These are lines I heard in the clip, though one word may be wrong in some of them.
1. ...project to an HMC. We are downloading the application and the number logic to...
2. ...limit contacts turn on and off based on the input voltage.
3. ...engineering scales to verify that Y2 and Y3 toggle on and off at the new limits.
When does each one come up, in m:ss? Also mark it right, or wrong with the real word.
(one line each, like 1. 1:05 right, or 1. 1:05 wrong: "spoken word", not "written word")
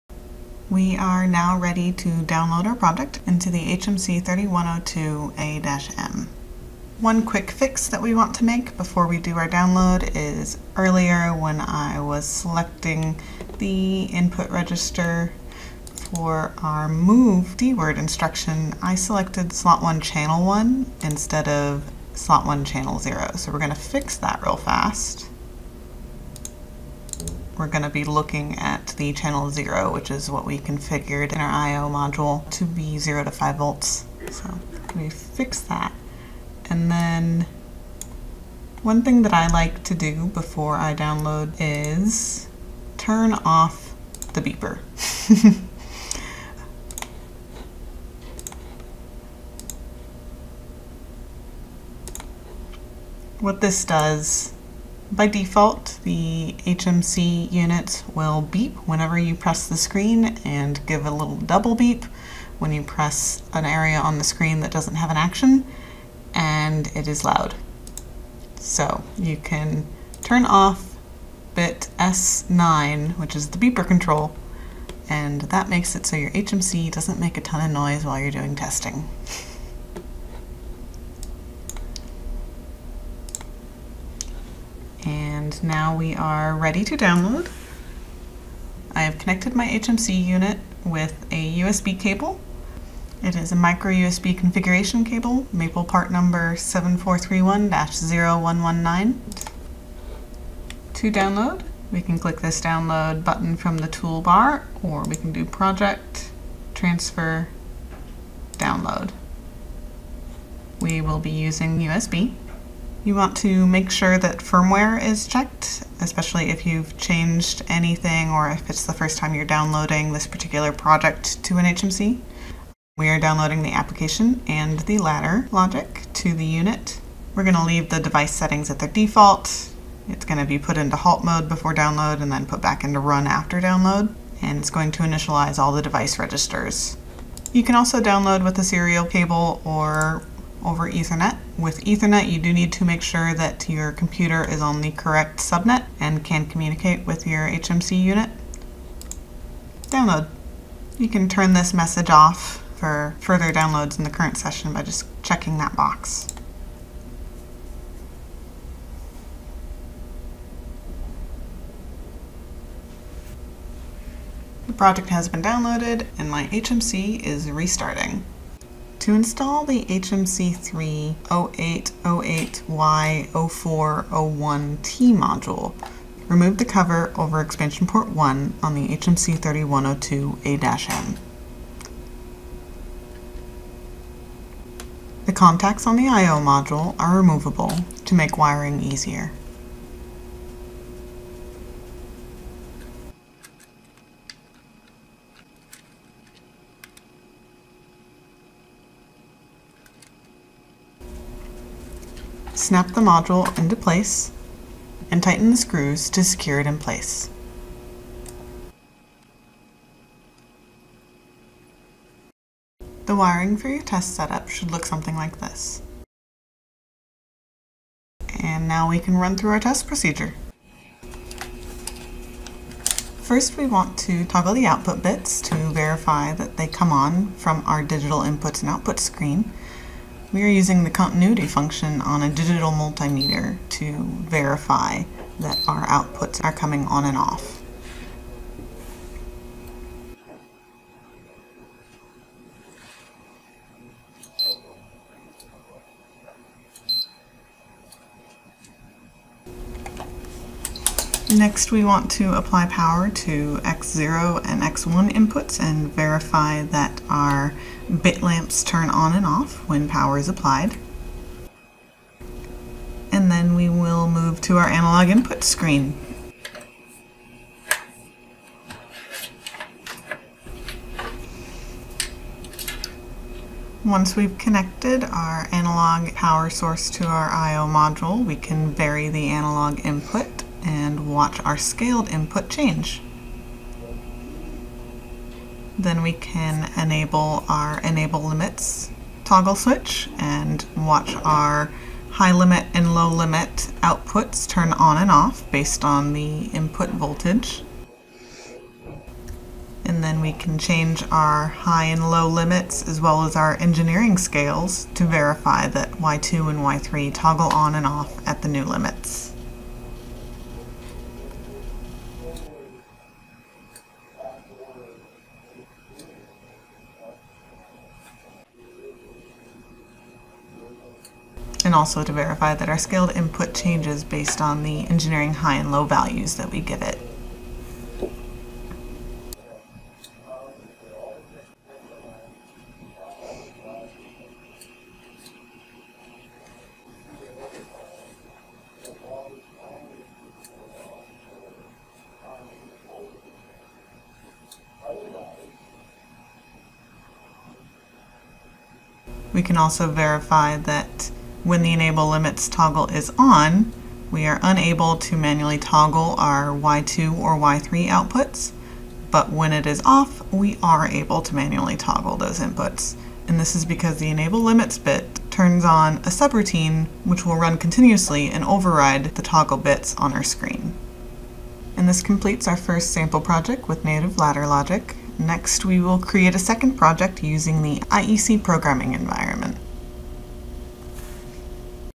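1. 2:00 wrong: "ladder", not "number"
2. 4:53 wrong: "outputs", not "contacts"
3. 5:03 right.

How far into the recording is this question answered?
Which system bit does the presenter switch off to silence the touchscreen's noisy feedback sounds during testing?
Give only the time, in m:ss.
1:11.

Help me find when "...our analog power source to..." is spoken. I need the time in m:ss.
4:35.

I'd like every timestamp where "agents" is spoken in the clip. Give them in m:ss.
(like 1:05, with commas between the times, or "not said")
not said.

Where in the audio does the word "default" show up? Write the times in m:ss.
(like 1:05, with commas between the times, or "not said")
0:55, 2:08.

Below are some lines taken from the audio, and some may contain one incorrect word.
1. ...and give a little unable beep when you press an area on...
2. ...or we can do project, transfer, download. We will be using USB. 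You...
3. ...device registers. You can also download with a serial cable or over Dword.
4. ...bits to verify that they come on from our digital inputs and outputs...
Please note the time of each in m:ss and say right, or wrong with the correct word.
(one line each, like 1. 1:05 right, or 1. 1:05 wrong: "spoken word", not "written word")
1. 1:00 wrong: "double", not "unable"
2. 1:44 right
3. 2:15 wrong: "Ethernet", not "Dword"
4. 3:45 right.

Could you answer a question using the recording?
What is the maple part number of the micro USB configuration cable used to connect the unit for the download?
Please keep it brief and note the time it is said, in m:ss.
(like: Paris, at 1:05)
7431-0119, at 1:36.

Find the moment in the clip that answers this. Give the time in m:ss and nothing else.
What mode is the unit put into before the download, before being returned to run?
2:10.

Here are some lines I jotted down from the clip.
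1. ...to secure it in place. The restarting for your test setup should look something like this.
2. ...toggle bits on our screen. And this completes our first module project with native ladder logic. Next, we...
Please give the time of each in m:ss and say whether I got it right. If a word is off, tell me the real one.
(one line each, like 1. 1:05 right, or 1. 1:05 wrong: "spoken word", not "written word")
1. 3:26 wrong: "wiring", not "restarting"
2. 6:09 wrong: "sample", not "module".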